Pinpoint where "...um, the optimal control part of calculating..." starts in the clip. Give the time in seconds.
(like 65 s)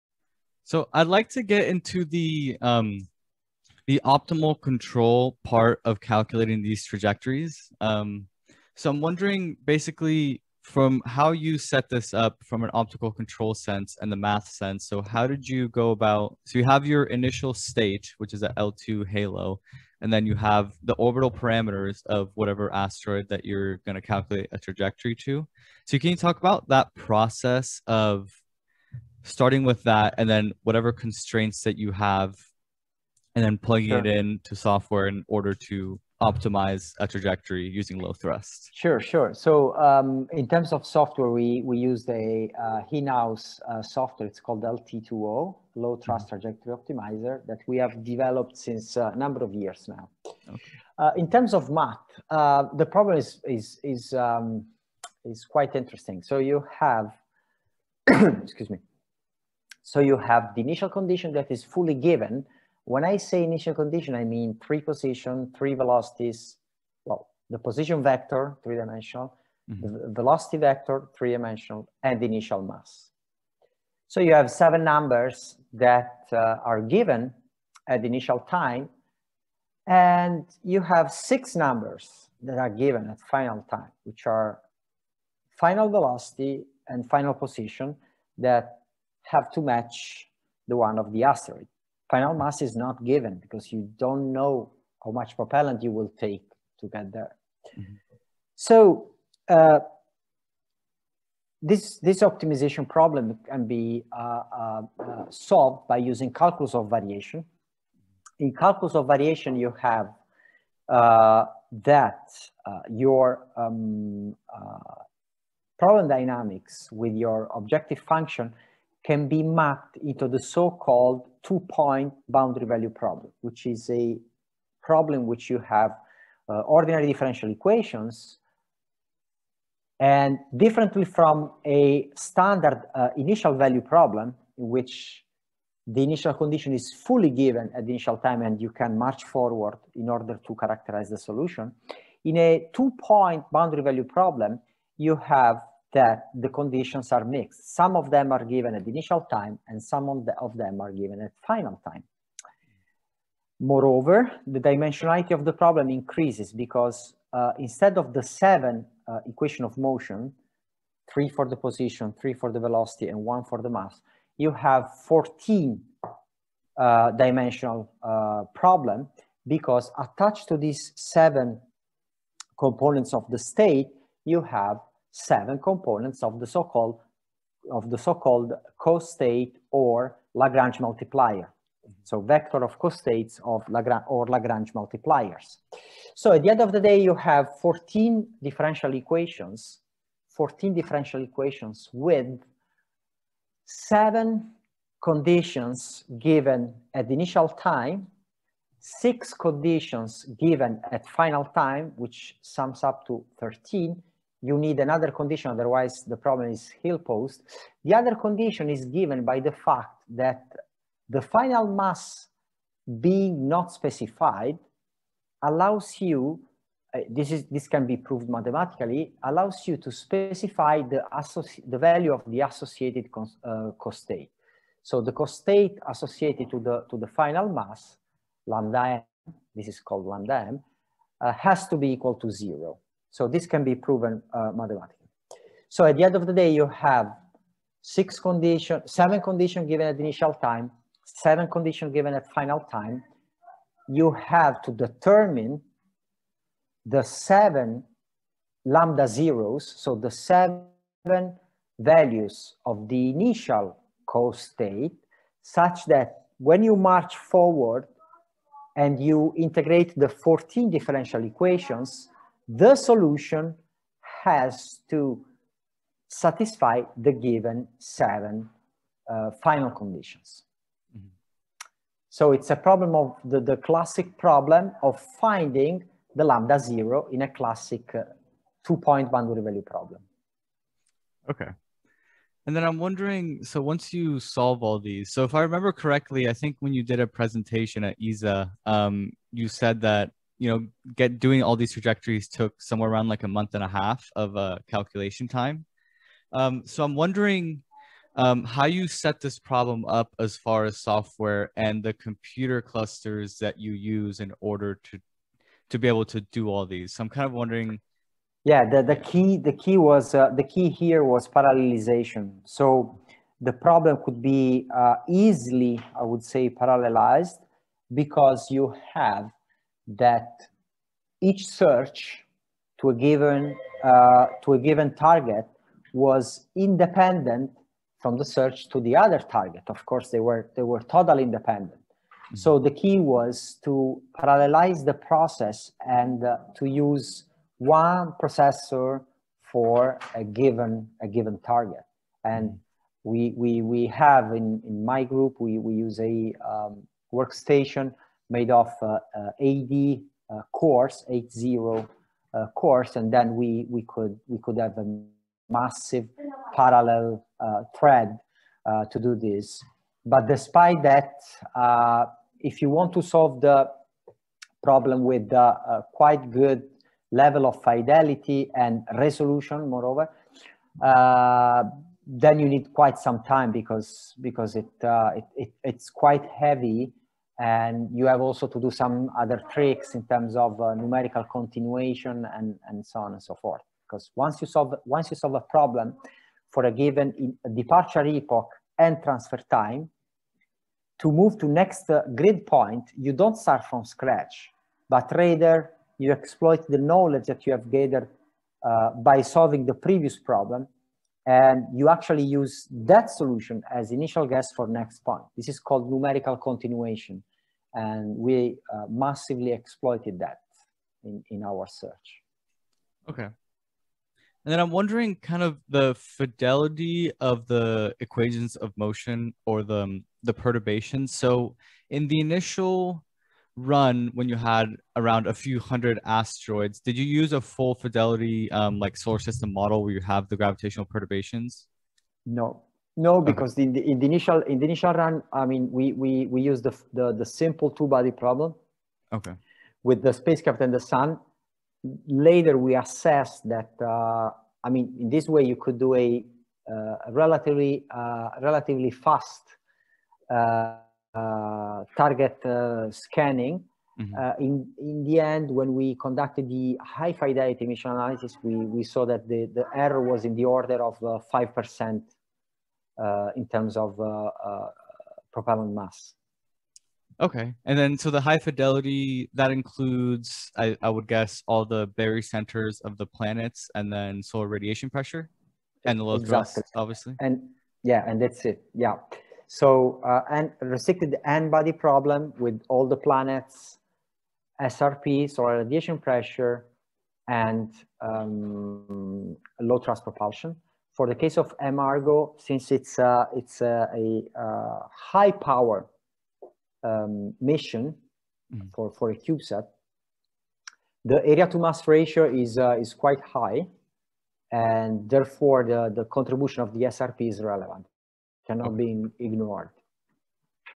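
2 s.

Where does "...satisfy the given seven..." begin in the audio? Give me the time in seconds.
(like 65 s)
266 s.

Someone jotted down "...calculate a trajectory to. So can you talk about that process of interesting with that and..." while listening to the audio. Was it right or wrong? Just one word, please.
wrong.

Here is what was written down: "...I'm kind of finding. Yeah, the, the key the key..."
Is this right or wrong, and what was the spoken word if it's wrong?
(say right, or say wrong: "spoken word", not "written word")
wrong: "wondering", not "finding".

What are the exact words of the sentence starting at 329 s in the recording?
Of course, they were they were totally independent.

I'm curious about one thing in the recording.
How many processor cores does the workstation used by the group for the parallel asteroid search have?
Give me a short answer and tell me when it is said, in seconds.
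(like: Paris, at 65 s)
80, at 351 s.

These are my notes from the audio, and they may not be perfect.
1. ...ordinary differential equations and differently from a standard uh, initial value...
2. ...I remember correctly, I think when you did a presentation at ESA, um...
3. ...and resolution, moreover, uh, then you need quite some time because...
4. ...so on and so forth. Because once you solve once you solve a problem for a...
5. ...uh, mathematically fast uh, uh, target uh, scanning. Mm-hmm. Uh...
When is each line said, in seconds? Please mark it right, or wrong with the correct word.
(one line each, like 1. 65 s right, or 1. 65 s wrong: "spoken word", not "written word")
1. 126 s right
2. 285 s right
3. 368 s right
4. 382 s right
5. 447 s wrong: "relatively", not "mathematically".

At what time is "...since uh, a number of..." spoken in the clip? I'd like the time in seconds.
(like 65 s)
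48 s.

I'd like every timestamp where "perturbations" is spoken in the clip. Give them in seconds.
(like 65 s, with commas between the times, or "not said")
420 s, 430 s.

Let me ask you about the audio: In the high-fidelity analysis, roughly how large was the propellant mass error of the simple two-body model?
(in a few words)
5%.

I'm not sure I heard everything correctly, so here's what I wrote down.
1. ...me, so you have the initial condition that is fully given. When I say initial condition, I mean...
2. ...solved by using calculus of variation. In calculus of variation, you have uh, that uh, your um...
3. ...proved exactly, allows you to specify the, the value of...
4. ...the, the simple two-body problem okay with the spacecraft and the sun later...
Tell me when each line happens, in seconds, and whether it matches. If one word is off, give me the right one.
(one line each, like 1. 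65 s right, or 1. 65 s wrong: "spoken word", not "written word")
1. 58 s right
2. 105 s right
3. 217 s wrong: "mathematically", not "exactly"
4. 436 s right.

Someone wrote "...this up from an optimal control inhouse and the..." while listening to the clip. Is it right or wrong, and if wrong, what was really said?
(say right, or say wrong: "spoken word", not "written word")
wrong: "sense", not "inhouse".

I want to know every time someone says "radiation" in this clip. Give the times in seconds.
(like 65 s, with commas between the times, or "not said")
474 s, 485 s.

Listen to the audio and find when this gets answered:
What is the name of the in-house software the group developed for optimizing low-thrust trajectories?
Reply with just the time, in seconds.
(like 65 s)
44 s.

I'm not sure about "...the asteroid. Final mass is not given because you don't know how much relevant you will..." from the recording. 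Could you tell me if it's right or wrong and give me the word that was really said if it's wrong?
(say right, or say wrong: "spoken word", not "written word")
wrong: "propellant", not "relevant".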